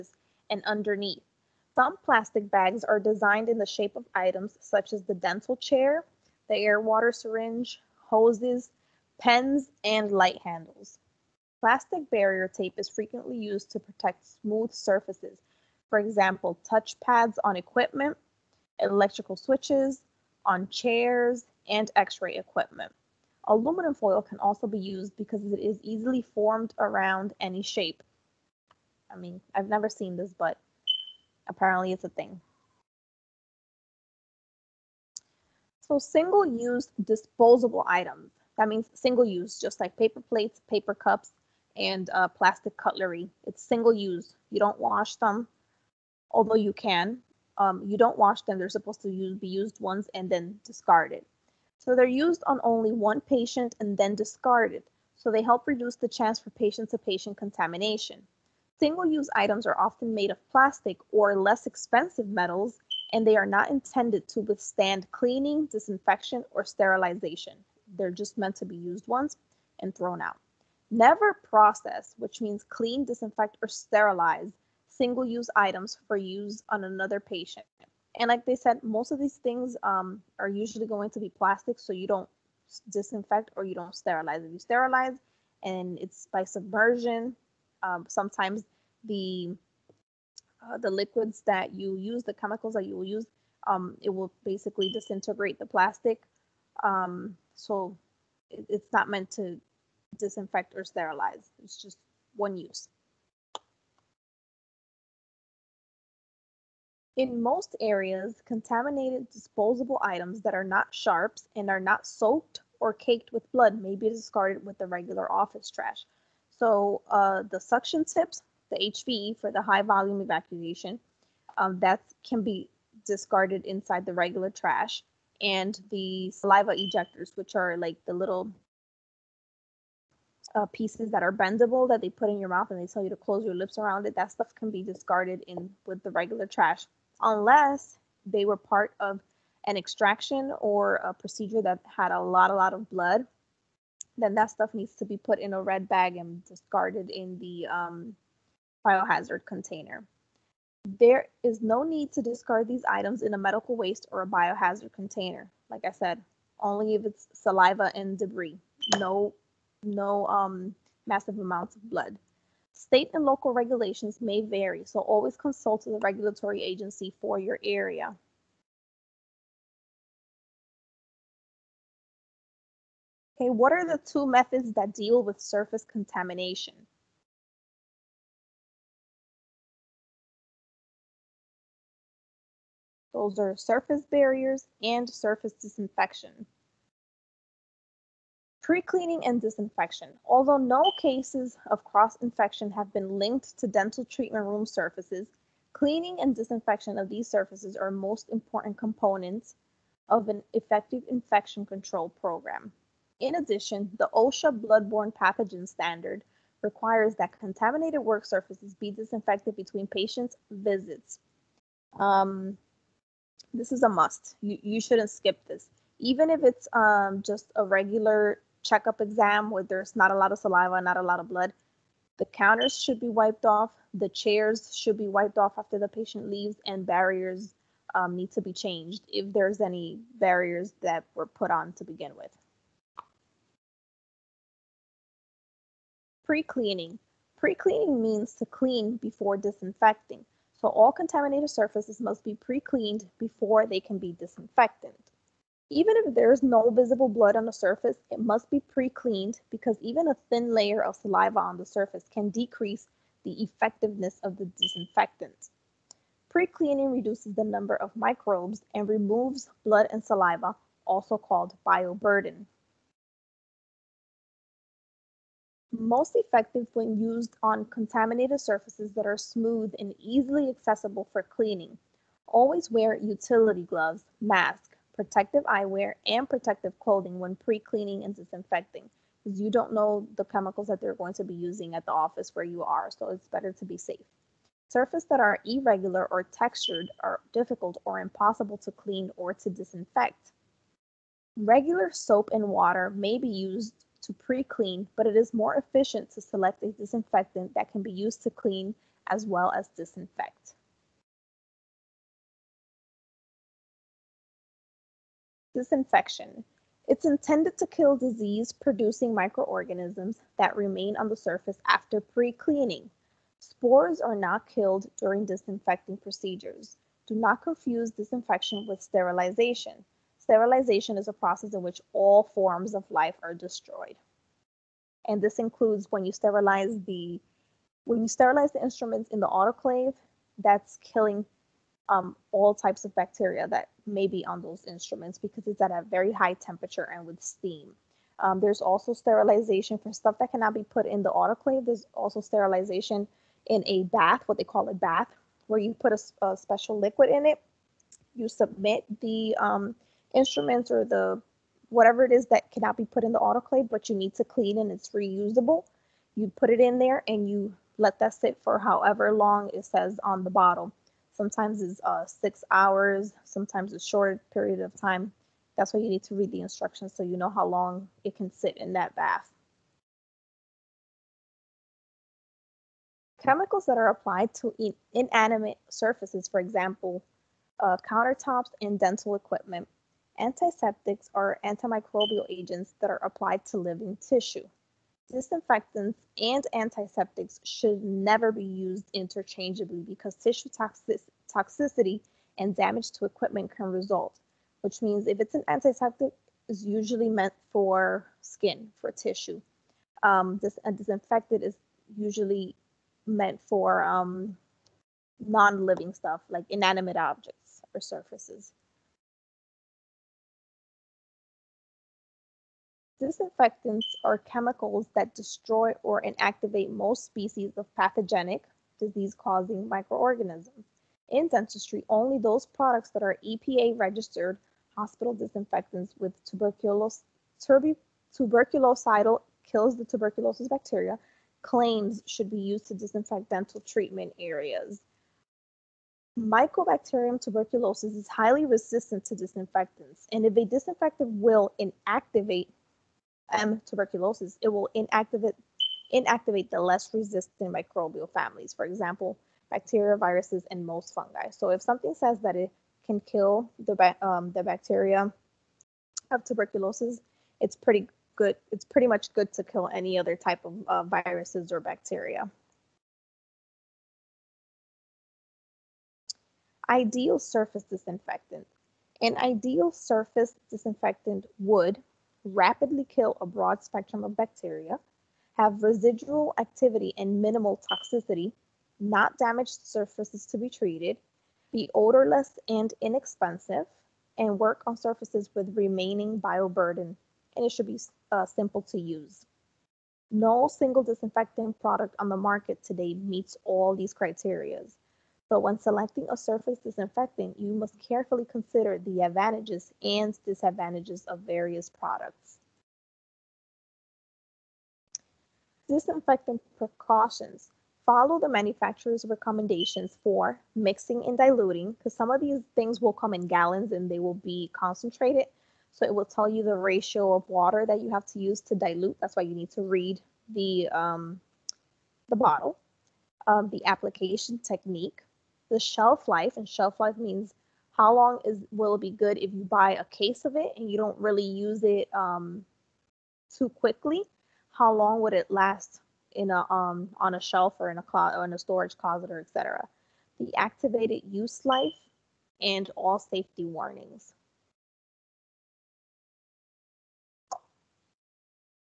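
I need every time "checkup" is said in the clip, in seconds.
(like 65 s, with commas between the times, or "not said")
218 s.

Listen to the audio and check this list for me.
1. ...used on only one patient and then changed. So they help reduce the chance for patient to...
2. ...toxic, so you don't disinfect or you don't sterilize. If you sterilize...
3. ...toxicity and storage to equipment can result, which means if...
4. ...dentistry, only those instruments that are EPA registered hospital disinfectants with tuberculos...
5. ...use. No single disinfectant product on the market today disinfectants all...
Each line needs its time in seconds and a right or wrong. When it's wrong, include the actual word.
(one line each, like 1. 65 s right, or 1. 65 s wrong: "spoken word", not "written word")
1. 52 s wrong: "discarded", not "changed"
2. 81 s wrong: "plastic", not "toxic"
3. 391 s wrong: "damage", not "storage"
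4. 421 s wrong: "products", not "instruments"
5. 488 s wrong: "meets", not "disinfectants".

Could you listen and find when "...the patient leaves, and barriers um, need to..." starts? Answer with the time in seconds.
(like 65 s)
225 s.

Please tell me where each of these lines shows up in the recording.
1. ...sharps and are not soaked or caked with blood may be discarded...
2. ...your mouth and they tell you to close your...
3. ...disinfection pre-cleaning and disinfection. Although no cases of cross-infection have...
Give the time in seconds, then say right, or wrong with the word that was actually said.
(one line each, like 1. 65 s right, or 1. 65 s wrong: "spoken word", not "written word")
1. 110 s right
2. 132 s right
3. 185 s right.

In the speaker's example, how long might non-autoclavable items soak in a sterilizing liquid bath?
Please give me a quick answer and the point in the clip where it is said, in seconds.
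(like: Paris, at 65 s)
6 hours, at 362 s.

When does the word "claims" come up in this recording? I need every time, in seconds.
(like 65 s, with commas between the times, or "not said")
431 s.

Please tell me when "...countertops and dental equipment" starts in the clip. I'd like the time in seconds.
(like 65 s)
377 s.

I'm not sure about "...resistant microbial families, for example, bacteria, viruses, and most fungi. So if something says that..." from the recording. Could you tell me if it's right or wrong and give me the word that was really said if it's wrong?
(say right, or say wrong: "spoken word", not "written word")
right.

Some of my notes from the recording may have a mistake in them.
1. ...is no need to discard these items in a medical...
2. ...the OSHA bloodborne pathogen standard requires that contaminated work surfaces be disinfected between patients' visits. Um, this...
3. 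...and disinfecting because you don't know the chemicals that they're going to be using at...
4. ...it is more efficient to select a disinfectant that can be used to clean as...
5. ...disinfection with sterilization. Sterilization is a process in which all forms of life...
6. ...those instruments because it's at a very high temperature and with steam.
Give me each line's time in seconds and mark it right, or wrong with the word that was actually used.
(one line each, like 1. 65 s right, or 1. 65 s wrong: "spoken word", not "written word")
1. 151 s right
2. 203 s right
3. 278 s right
4. 295 s right
5. 317 s right
6. 334 s right.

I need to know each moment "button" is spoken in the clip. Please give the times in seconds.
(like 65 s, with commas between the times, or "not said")
not said.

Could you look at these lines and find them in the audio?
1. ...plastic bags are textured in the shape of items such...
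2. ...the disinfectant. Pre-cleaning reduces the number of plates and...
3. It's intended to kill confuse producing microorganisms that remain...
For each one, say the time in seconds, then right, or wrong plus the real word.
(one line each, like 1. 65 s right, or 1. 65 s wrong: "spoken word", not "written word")
1. 2 s wrong: "designed", not "textured"
2. 254 s wrong: "microbes", not "plates"
3. 306 s wrong: "disease", not "confuse".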